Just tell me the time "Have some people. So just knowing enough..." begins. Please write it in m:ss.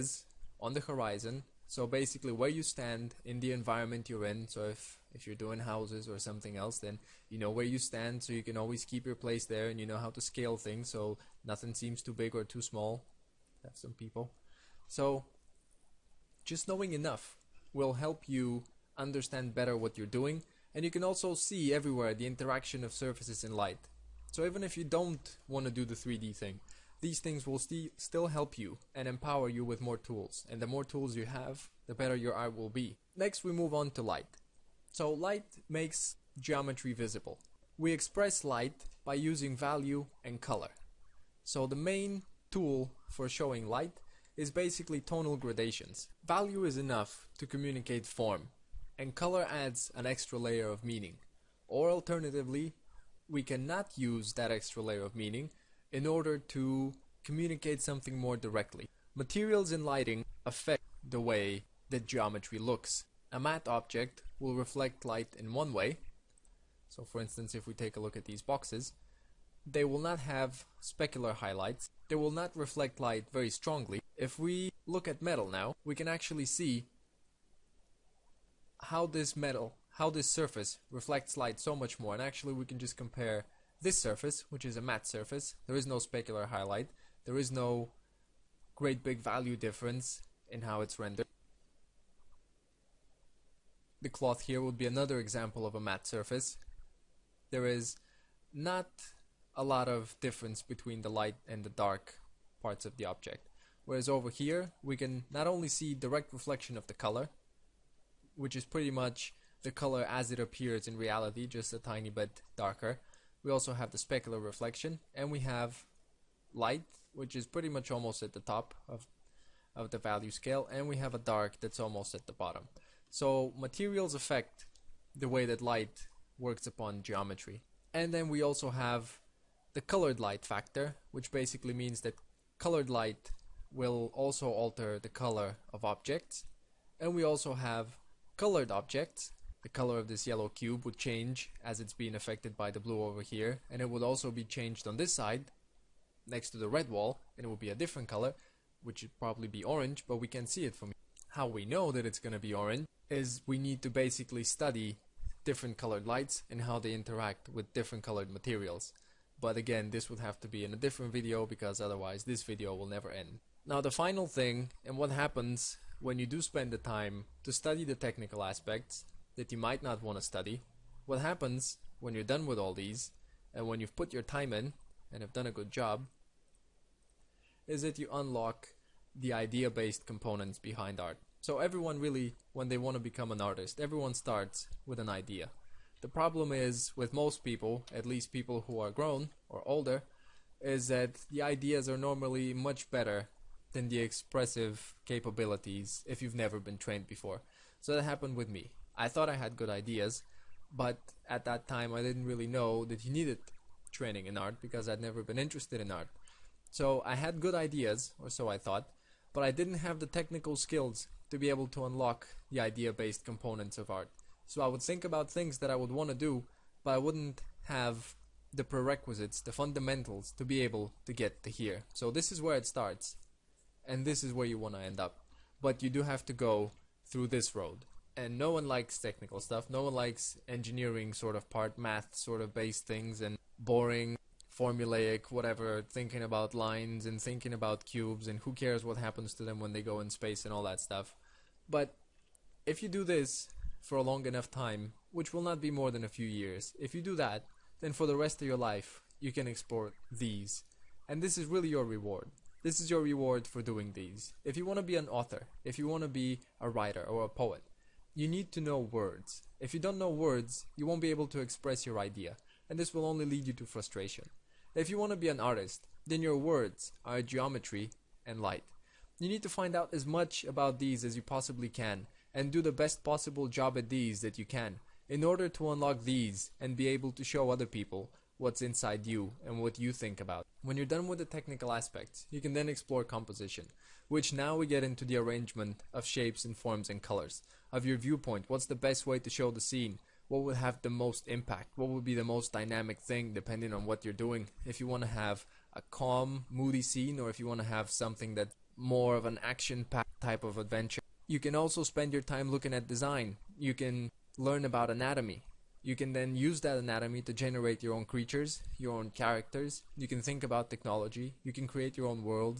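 0:13.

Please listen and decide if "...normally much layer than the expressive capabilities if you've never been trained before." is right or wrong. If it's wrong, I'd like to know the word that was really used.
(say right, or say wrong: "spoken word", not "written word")
wrong: "better", not "layer".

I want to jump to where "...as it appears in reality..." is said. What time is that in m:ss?
1:50.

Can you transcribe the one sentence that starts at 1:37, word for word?
There is not a lot of difference between the light and the dark parts of the object.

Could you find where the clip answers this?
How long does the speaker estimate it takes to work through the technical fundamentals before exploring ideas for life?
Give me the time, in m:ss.
4:06.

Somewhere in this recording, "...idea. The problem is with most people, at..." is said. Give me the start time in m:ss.
3:05.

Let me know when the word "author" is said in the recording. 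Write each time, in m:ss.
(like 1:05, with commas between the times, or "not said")
4:15.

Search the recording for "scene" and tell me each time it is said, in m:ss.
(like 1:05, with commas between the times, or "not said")
4:49, 4:56.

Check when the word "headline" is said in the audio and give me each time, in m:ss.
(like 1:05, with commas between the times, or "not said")
not said.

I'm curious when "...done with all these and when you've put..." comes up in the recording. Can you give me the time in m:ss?
2:52.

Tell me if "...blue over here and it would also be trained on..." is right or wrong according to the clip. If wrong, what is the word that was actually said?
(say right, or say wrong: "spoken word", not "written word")
wrong: "changed", not "trained".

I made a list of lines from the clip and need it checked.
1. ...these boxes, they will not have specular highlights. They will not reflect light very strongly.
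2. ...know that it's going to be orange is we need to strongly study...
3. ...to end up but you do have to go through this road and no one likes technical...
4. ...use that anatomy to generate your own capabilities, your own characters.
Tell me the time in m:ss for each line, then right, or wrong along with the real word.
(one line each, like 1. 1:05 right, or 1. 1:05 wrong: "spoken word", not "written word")
1. 1:08 right
2. 2:31 wrong: "basically", not "strongly"
3. 3:44 right
4. 5:06 wrong: "creatures", not "capabilities".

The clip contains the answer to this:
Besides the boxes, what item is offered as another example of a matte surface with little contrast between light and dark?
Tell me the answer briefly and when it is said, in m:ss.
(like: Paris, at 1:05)
cloth, at 1:34.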